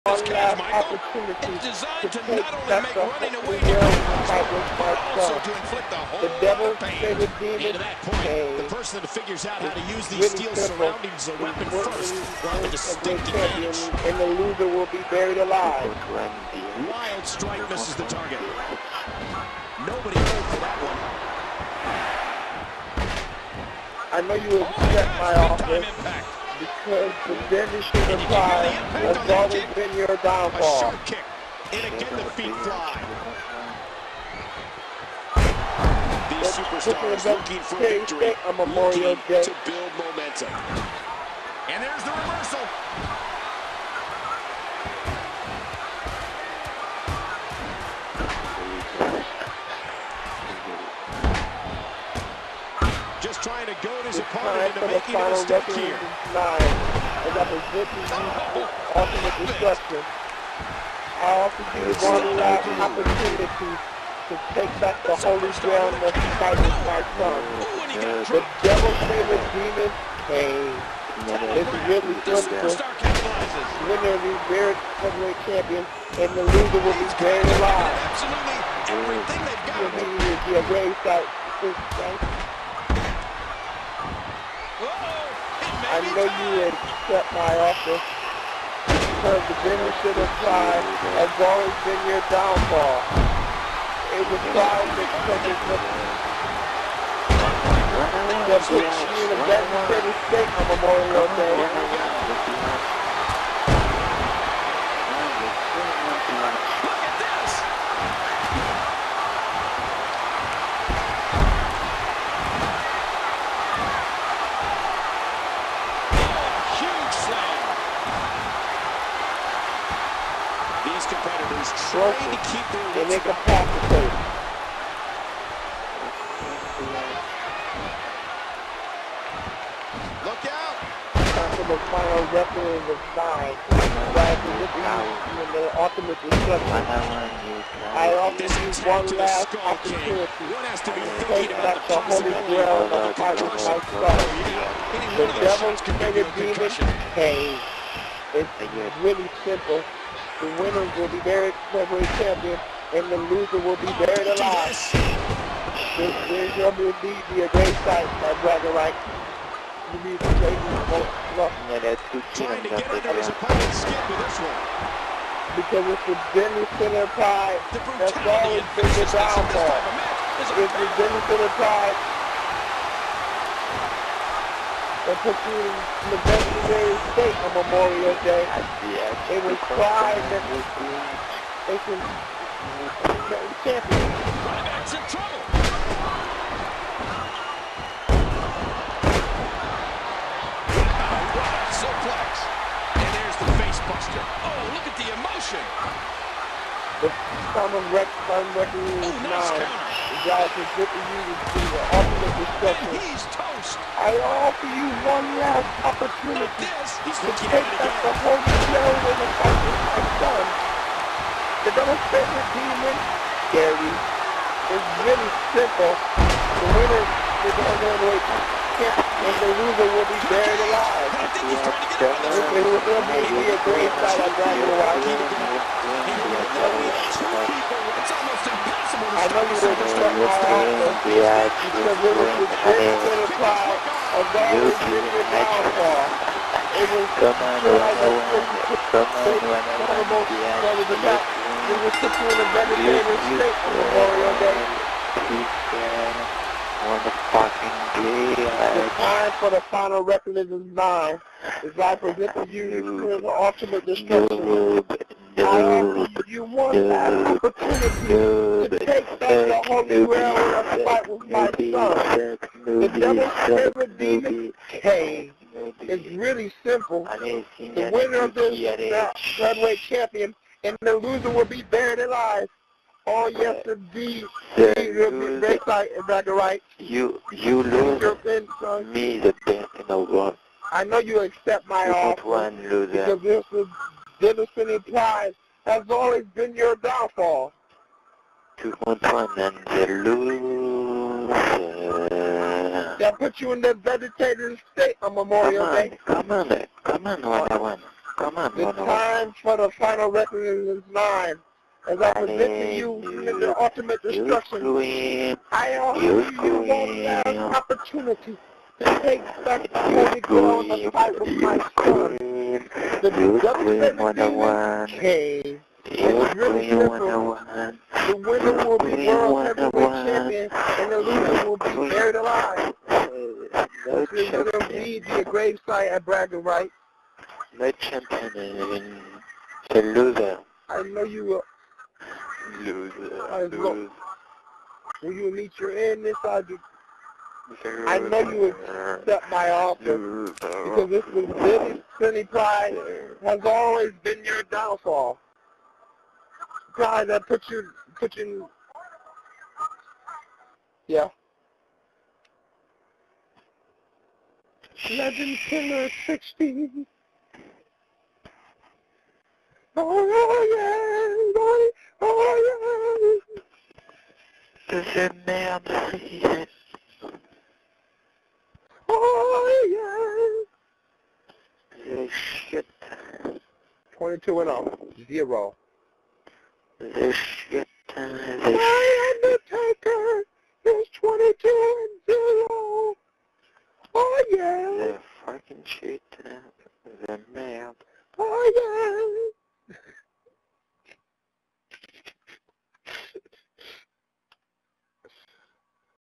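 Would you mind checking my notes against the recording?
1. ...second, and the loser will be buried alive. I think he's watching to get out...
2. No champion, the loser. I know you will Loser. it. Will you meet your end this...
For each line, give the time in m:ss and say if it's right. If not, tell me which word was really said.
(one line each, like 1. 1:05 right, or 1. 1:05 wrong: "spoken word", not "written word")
1. 3:38 wrong: "trying", not "watching"
2. 5:27 right.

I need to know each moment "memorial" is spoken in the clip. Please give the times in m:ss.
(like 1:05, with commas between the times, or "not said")
0:38, 1:40, 2:57, 4:03, 4:55.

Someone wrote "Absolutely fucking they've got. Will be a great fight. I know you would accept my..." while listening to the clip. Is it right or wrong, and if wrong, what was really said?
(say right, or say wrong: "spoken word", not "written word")
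wrong: "everything", not "fucking".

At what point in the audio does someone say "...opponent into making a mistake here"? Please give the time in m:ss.
0:54.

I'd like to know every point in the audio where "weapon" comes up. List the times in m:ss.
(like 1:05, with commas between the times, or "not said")
0:11, 2:12.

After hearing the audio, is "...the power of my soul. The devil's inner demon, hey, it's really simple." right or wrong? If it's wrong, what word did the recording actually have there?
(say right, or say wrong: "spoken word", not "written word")
right.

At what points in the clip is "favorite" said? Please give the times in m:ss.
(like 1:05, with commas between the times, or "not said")
1:09, 4:23.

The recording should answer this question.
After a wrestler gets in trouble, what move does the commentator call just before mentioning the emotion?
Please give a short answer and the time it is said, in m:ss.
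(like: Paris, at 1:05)
Face buster, at 3:13.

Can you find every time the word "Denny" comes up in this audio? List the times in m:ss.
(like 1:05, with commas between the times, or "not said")
2:46, 2:50.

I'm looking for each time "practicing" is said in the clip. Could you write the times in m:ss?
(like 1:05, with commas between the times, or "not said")
not said.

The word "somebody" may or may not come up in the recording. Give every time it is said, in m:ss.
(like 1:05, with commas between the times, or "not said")
not said.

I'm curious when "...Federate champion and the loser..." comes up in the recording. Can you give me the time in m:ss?
4:29.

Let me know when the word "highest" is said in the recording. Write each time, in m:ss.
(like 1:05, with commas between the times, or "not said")
not said.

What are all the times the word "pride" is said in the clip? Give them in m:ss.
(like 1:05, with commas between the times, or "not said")
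1:34, 2:47, 2:51, 2:59, 5:42, 5:46.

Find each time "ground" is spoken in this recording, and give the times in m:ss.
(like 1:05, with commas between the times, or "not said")
1:05, 5:10.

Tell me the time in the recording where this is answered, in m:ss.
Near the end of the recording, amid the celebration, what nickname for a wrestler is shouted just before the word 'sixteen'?
5:54.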